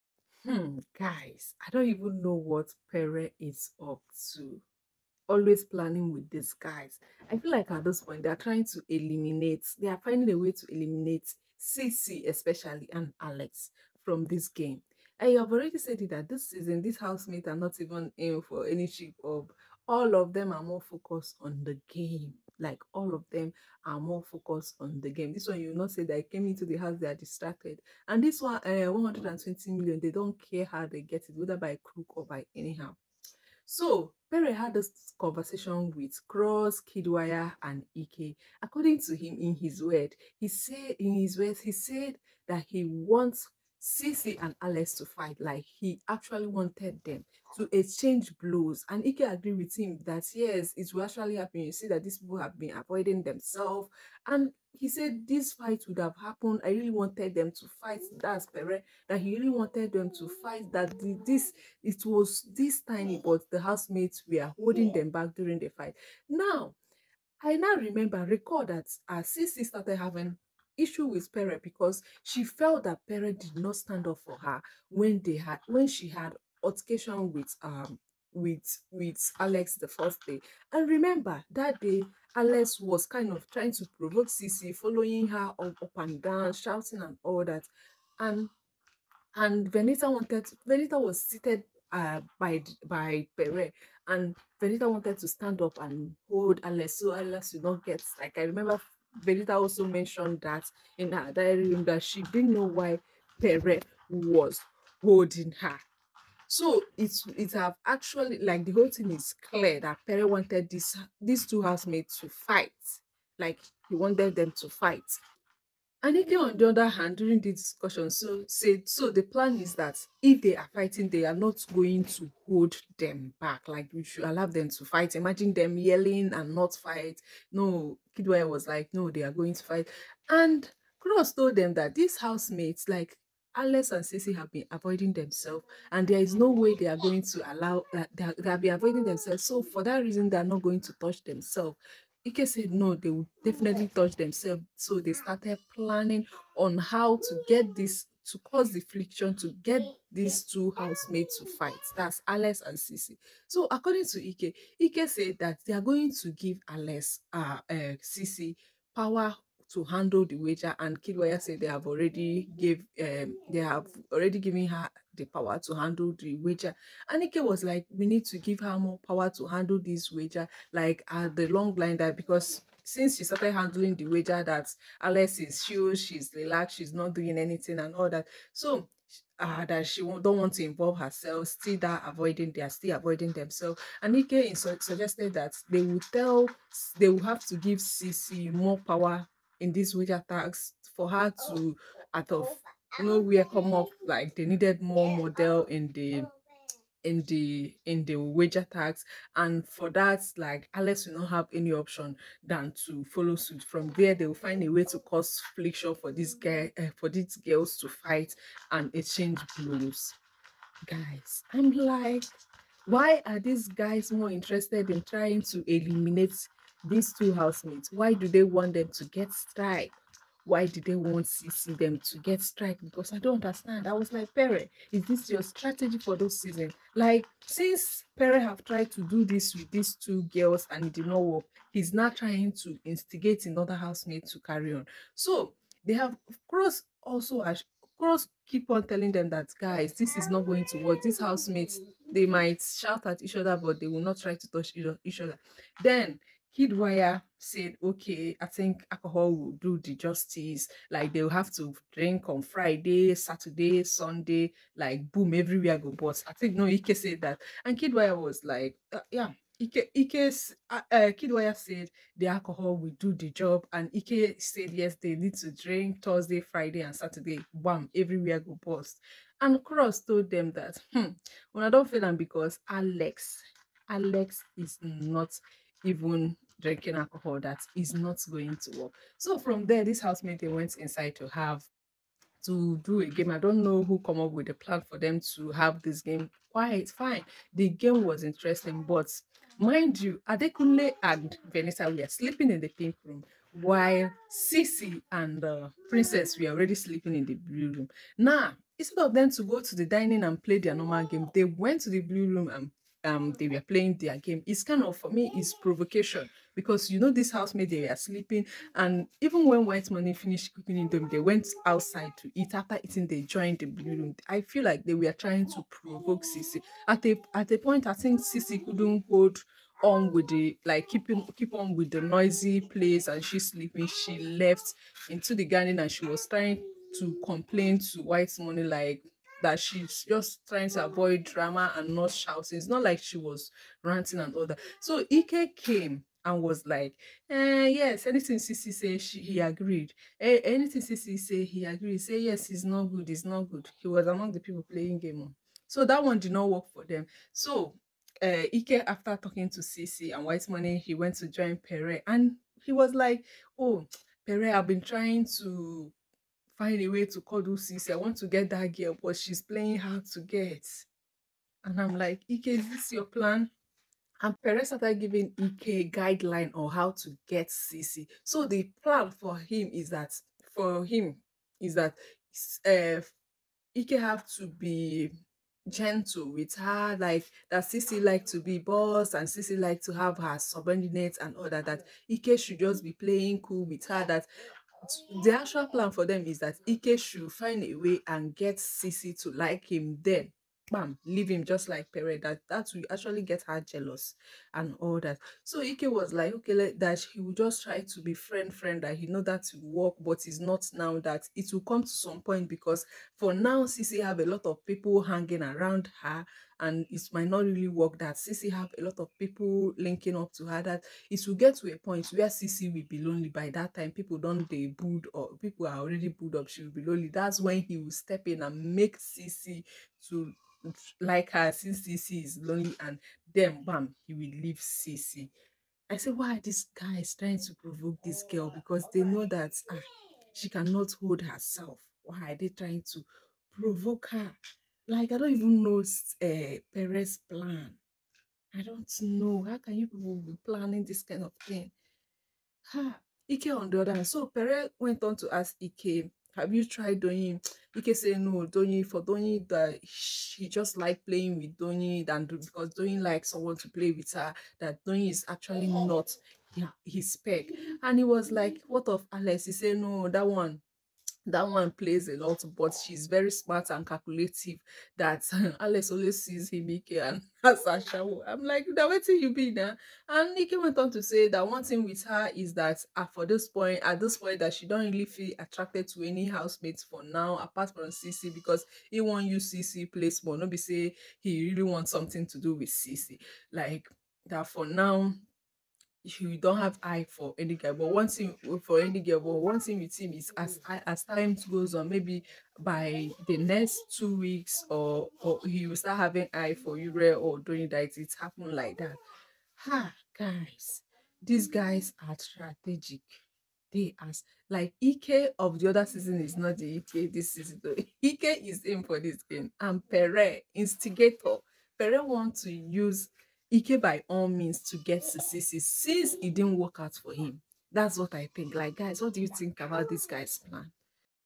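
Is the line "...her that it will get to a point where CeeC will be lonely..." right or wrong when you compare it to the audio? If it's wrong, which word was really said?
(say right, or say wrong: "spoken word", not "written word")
right.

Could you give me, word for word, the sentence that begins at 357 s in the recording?
I want to get that girl, but she's playing hard to get.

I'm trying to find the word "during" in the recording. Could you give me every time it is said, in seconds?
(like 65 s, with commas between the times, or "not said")
65 s, 117 s.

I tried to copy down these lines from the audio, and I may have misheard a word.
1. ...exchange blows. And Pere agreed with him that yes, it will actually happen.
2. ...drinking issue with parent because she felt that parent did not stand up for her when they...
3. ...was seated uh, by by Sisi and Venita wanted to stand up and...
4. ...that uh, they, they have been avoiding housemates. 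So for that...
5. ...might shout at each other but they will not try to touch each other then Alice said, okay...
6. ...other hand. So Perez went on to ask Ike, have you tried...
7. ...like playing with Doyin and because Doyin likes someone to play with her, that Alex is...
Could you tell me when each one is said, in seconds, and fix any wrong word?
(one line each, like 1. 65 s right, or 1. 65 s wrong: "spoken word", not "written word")
1. 47 s wrong: "Ike", not "Pere"
2. 69 s wrong: "having", not "drinking"
3. 90 s wrong: "Pere", not "Sisi"
4. 137 s wrong: "themselves", not "housemates"
5. 242 s wrong: "Kid", not "Alice"
6. 443 s right
7. 450 s wrong: "Doyin", not "Alex".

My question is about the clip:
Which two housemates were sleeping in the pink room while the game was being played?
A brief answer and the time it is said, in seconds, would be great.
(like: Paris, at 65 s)
Adekunle and Vanessa, at 290 s.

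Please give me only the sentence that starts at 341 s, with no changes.
Say yes, it's not good, it's not good.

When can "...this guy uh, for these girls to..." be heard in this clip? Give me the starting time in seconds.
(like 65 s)
206 s.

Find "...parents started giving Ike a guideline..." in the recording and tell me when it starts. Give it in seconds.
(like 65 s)
364 s.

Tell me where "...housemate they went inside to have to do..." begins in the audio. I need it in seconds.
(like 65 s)
280 s.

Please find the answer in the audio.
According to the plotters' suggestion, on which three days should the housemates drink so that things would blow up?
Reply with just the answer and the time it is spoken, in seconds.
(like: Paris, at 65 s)
Thursday, Friday, and Saturday, at 266 s.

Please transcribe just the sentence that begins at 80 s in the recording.
And remember that day Alex was kind of trying to provoke CeeC, following her up, up and down, shouting and all that.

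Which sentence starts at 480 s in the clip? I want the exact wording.
Nobody say he really wants something to do with CC.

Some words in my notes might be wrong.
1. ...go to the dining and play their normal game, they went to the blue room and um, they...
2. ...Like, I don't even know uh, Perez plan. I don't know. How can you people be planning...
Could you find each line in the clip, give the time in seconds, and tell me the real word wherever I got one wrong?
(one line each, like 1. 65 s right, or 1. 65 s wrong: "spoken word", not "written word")
1. 299 s right
2. 434 s right.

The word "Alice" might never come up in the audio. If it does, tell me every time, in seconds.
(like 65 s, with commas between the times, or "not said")
152 s, 156 s.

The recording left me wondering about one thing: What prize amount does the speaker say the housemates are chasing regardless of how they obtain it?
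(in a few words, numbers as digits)
120 million.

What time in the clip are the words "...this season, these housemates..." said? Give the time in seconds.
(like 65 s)
16 s.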